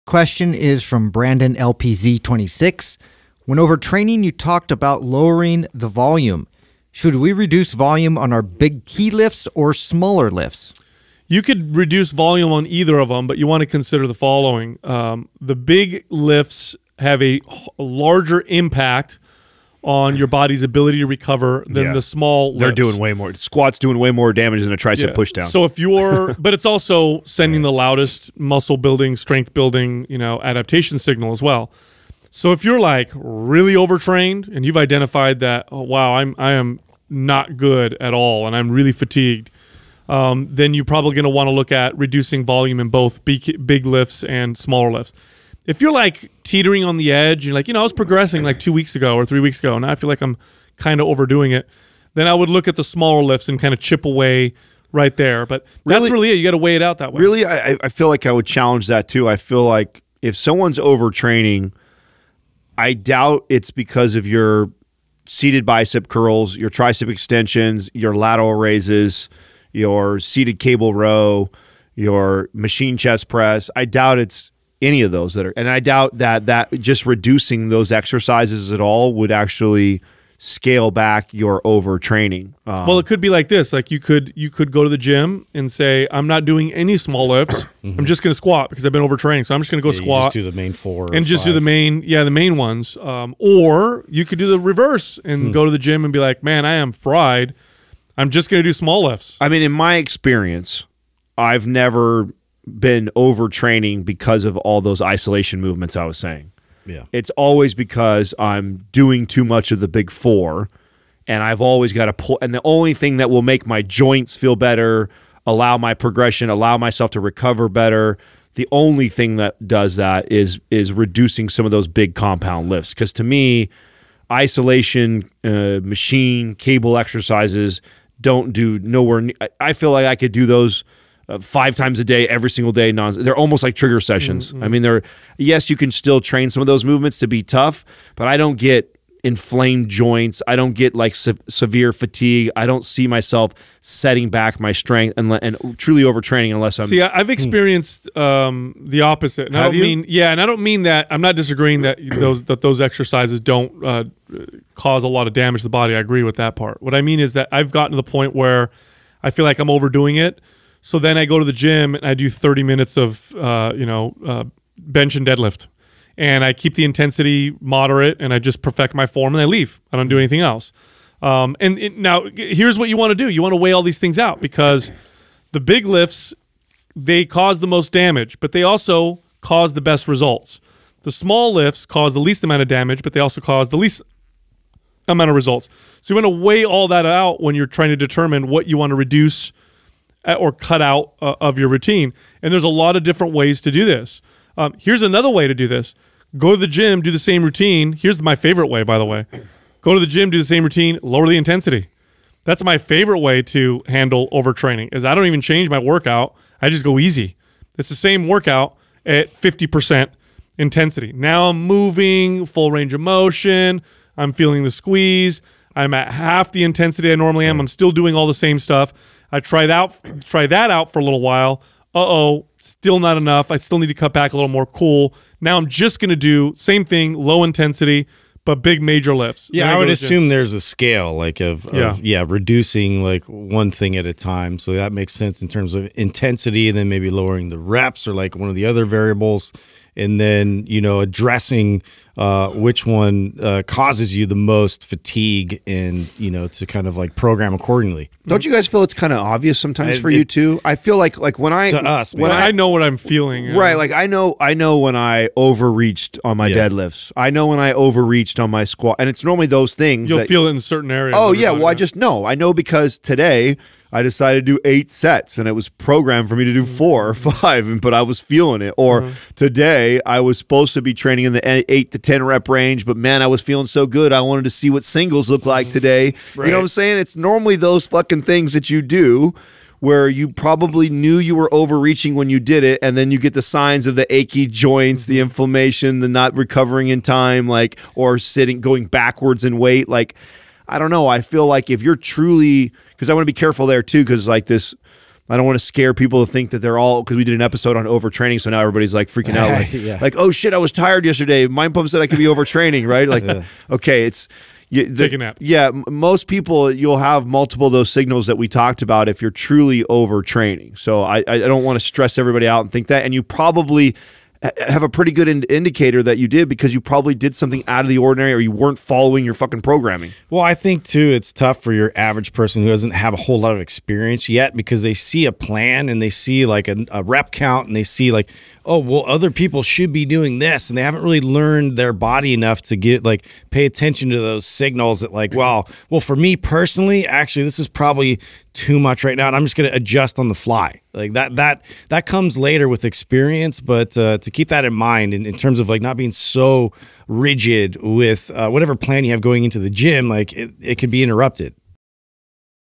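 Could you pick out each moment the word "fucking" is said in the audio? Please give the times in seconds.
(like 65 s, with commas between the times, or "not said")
277 s, 319 s.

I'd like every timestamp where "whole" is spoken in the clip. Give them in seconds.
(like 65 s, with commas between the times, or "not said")
323 s.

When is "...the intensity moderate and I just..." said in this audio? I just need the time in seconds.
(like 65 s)
166 s.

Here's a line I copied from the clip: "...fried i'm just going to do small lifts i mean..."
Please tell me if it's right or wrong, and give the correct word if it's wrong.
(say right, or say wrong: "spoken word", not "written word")
right.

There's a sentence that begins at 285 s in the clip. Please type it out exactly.
inflammation the not recovering in time like or sitting going backwards in weight like I don't know.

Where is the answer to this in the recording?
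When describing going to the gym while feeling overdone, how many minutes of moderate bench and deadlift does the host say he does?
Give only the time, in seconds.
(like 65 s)
162 s.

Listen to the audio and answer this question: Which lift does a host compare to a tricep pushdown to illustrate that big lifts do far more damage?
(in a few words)
Squats.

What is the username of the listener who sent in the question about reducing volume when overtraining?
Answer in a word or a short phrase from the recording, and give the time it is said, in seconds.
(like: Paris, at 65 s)
Brandon LPZ26, at 1 s.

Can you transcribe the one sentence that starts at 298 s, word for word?
So now everybody's like freaking out.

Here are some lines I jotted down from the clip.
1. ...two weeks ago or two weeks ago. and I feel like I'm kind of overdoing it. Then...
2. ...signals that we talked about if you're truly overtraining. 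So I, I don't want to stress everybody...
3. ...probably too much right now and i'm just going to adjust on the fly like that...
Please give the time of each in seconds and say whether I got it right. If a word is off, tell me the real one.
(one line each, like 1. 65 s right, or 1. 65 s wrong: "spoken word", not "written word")
1. 48 s wrong: "three", not "two"
2. 307 s right
3. 337 s right.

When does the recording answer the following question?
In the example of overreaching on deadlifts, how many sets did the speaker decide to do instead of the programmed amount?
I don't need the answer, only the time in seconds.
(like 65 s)
264 s.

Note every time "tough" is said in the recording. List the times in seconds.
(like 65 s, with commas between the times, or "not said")
137 s, 321 s.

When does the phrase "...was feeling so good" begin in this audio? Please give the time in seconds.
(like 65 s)
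273 s.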